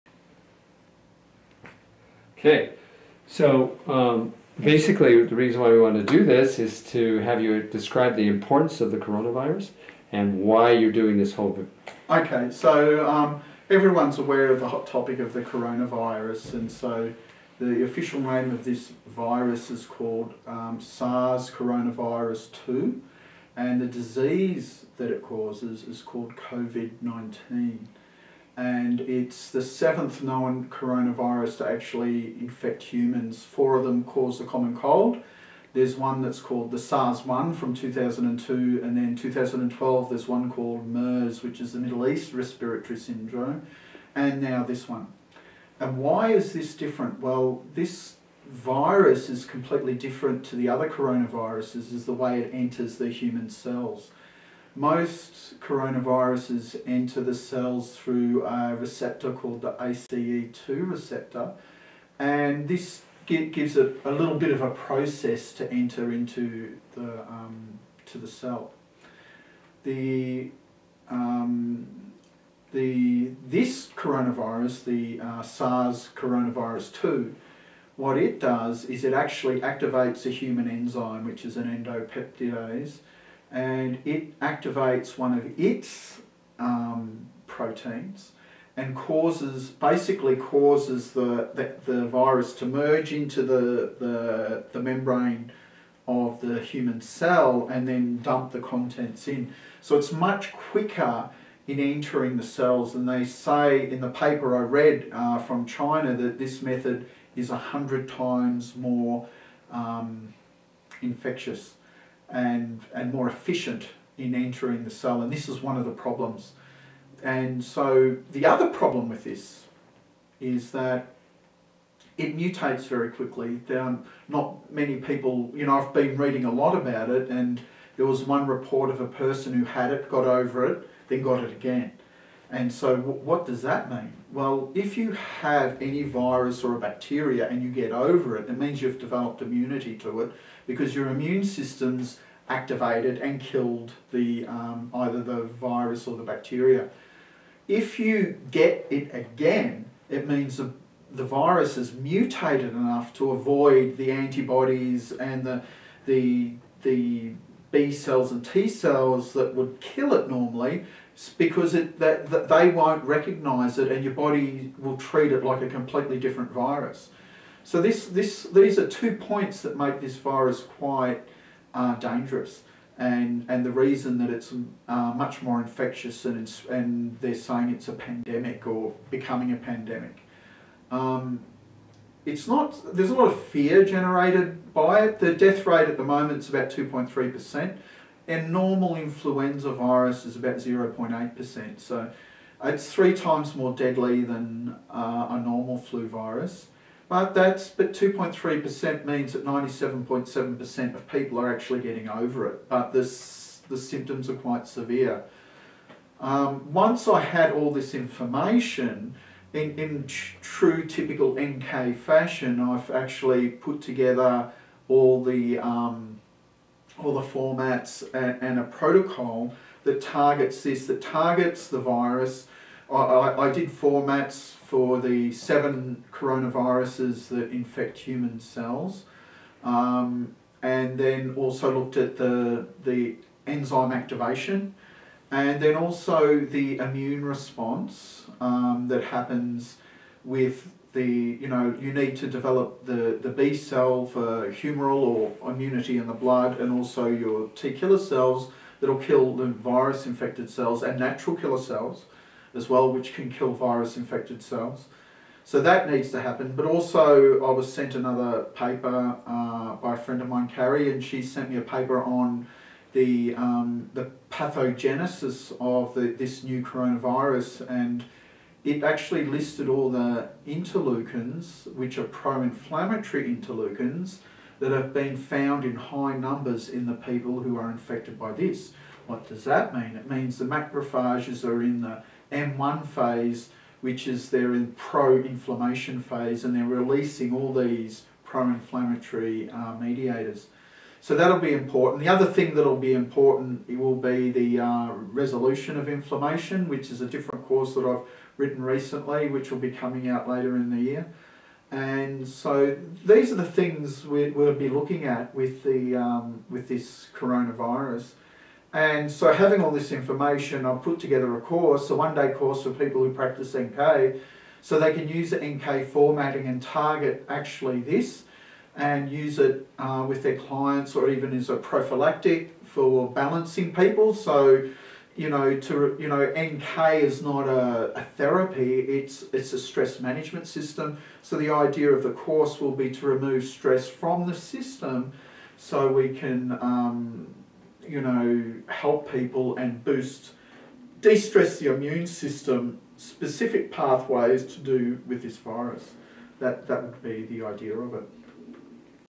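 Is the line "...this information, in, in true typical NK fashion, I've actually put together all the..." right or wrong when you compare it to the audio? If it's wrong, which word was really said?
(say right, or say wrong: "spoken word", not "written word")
right.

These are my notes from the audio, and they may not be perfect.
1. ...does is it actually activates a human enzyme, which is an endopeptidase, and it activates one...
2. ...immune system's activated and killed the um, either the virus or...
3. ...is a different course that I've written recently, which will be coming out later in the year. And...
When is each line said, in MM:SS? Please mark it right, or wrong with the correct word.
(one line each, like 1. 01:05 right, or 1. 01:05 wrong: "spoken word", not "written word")
1. 01:18 right
2. 02:21 right
3. 04:56 right.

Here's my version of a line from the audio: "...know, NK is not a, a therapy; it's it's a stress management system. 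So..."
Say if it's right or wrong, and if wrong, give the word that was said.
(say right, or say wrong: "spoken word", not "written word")
right.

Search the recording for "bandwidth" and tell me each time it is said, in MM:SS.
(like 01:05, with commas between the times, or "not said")
not said.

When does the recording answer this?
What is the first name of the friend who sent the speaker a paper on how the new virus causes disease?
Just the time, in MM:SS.
04:20.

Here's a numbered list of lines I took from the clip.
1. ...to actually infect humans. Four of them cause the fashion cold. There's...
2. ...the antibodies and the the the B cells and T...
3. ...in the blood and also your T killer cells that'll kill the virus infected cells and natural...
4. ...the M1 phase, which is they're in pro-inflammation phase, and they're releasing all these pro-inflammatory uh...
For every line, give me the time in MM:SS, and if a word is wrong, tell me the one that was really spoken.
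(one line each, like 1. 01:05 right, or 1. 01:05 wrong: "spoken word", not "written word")
1. 00:31 wrong: "common", not "fashion"
2. 02:33 right
3. 04:05 right
4. 04:41 right.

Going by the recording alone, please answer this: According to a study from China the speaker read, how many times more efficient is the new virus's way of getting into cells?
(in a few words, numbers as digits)
100.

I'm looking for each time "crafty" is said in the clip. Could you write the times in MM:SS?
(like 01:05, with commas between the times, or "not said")
not said.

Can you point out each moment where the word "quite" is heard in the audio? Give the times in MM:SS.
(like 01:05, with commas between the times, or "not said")
02:50, 03:24.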